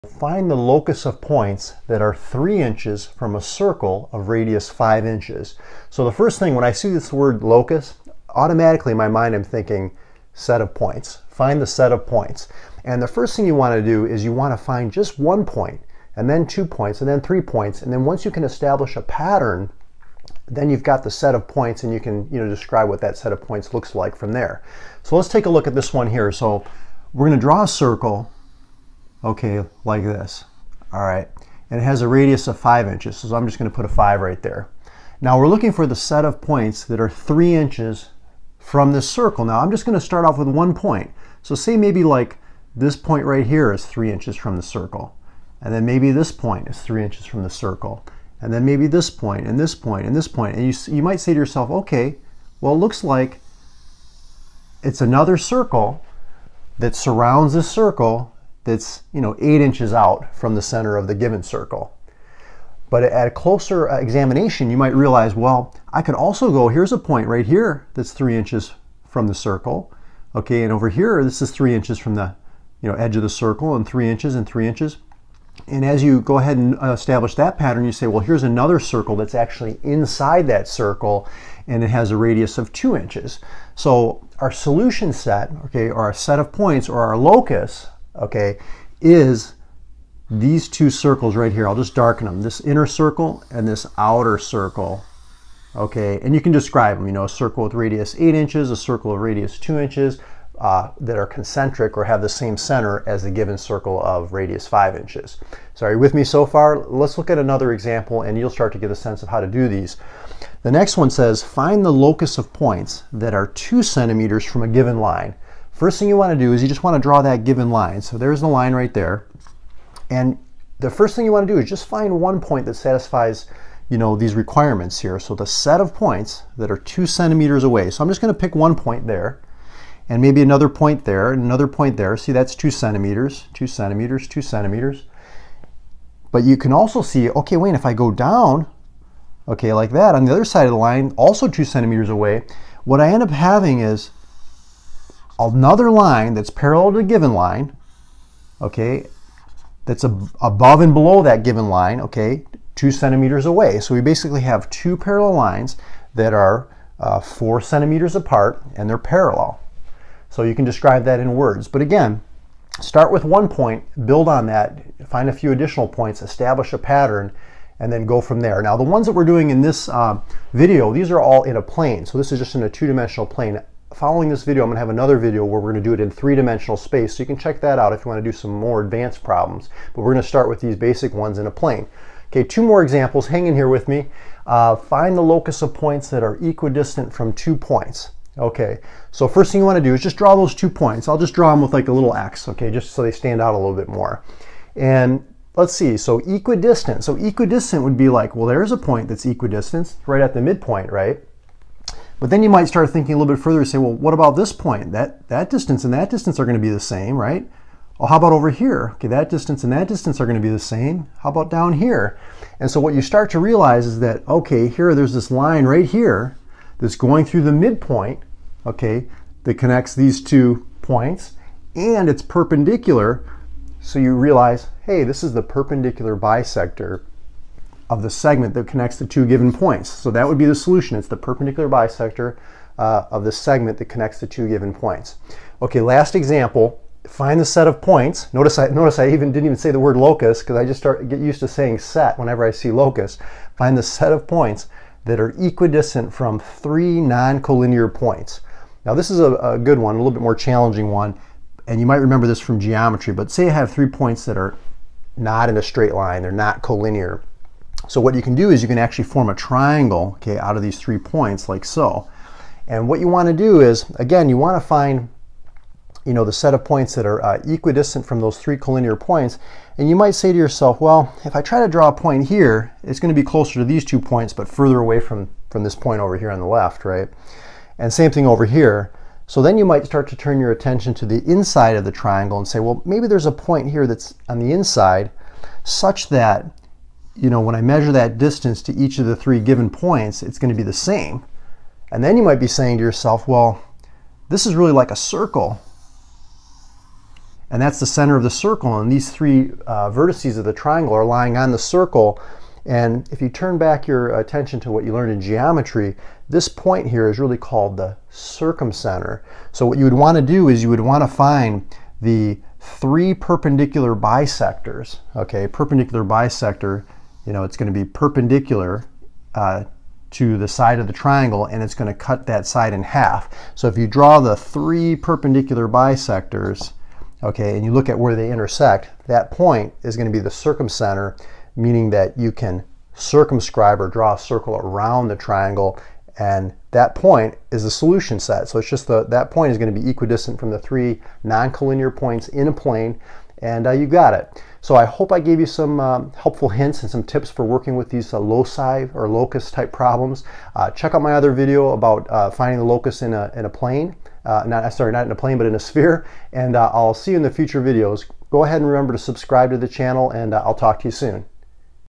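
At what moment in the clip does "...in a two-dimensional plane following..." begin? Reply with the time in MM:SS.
02:52.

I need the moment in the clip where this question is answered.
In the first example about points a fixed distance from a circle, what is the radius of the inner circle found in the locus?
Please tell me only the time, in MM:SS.
01:22.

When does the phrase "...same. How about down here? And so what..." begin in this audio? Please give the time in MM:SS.
03:30.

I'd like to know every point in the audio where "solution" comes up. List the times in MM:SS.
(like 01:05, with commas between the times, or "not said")
01:24, 03:50, 05:37.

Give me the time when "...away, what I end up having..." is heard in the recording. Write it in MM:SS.
02:22.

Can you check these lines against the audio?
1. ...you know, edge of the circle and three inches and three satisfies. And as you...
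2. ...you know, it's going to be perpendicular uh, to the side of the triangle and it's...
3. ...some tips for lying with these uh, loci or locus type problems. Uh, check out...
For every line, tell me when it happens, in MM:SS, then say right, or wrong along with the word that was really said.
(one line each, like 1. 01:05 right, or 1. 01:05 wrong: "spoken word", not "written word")
1. 01:12 wrong: "inches", not "satisfies"
2. 05:17 right
3. 05:46 wrong: "working", not "lying".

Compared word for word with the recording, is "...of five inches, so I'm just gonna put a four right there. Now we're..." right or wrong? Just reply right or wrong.
wrong.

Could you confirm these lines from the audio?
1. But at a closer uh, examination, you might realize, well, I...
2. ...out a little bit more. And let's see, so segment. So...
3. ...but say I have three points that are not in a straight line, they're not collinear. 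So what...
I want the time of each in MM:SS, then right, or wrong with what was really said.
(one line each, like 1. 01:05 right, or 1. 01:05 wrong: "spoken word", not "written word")
1. 01:02 right
2. 03:13 wrong: "equidistant", not "segment"
3. 04:13 right.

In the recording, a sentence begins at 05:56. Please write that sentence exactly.
And I'll see you in the future videos.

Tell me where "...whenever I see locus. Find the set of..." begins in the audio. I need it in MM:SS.
04:02.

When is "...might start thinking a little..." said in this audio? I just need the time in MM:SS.
03:22.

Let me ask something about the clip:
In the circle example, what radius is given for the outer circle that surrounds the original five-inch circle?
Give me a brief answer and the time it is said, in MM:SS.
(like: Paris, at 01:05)
8 inches, at 01:37.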